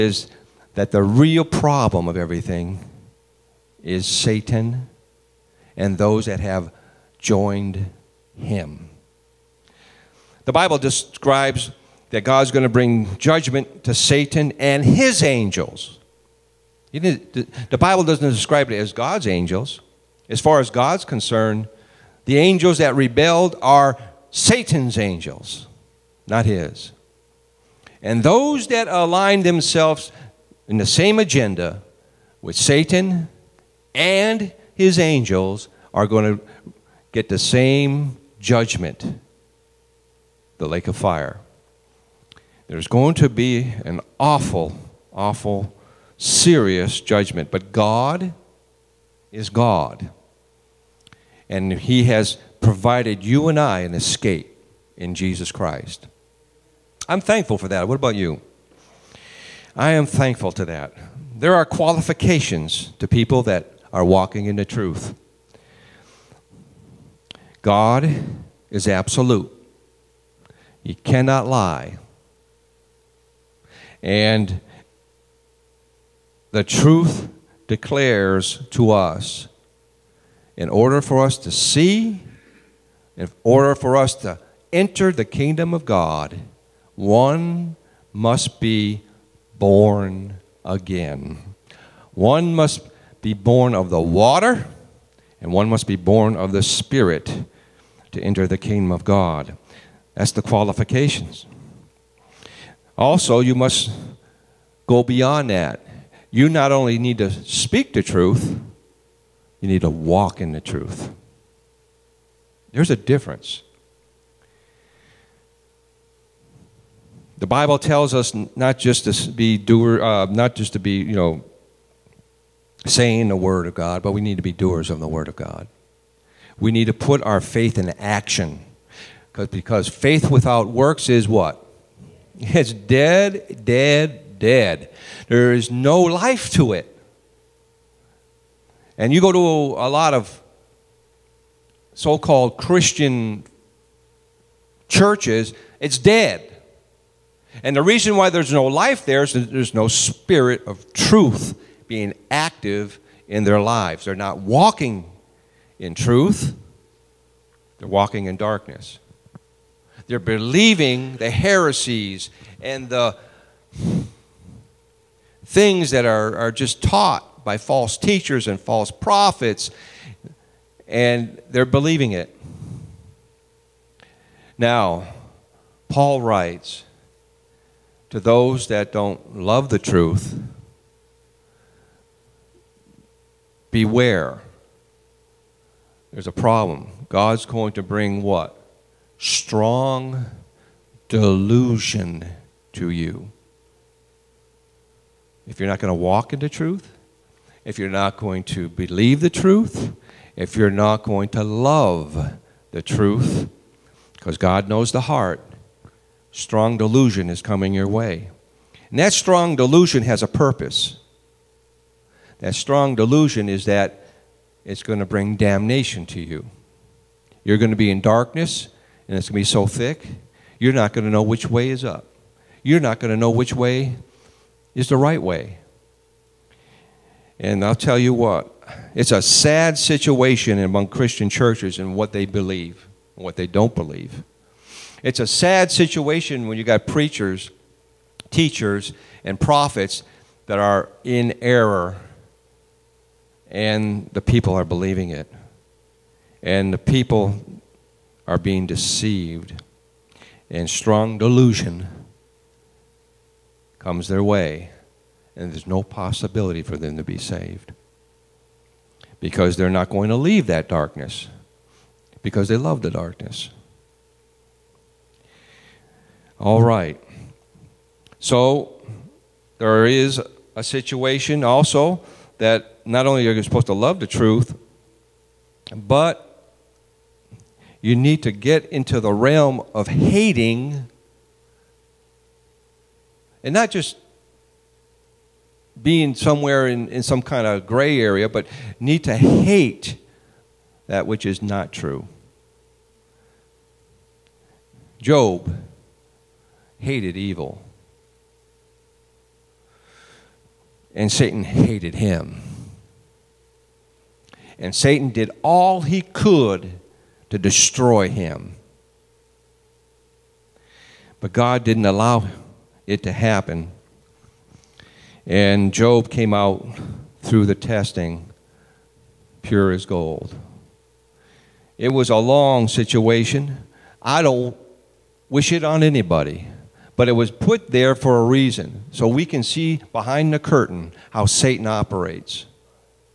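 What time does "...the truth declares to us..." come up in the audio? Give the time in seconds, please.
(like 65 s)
76 s.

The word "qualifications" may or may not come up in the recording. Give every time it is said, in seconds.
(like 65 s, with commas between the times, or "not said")
61 s, 100 s.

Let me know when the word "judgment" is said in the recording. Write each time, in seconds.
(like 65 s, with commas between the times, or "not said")
13 s, 38 s, 46 s.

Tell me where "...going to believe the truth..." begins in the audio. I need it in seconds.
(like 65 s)
198 s.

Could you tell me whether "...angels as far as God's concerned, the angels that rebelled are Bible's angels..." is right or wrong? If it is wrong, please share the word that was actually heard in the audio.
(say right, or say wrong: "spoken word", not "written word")
wrong: "Satan", not "Bible".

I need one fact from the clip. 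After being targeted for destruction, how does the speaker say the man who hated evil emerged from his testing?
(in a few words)
Pure as gold.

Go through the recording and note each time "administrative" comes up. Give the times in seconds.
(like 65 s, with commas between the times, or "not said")
not said.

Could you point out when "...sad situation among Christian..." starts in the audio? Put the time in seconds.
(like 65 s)
229 s.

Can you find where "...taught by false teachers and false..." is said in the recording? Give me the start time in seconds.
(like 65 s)
166 s.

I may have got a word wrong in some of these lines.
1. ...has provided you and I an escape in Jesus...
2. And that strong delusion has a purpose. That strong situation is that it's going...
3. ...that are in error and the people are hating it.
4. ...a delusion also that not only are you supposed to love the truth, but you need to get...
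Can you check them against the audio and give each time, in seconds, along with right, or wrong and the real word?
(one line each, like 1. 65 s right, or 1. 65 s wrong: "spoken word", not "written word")
1. 52 s right
2. 208 s wrong: "delusion", not "situation"
3. 240 s wrong: "believing", not "hating"
4. 270 s wrong: "situation", not "delusion".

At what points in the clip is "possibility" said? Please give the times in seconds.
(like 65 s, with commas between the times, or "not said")
255 s.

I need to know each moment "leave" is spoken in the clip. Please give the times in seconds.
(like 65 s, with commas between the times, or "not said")
260 s.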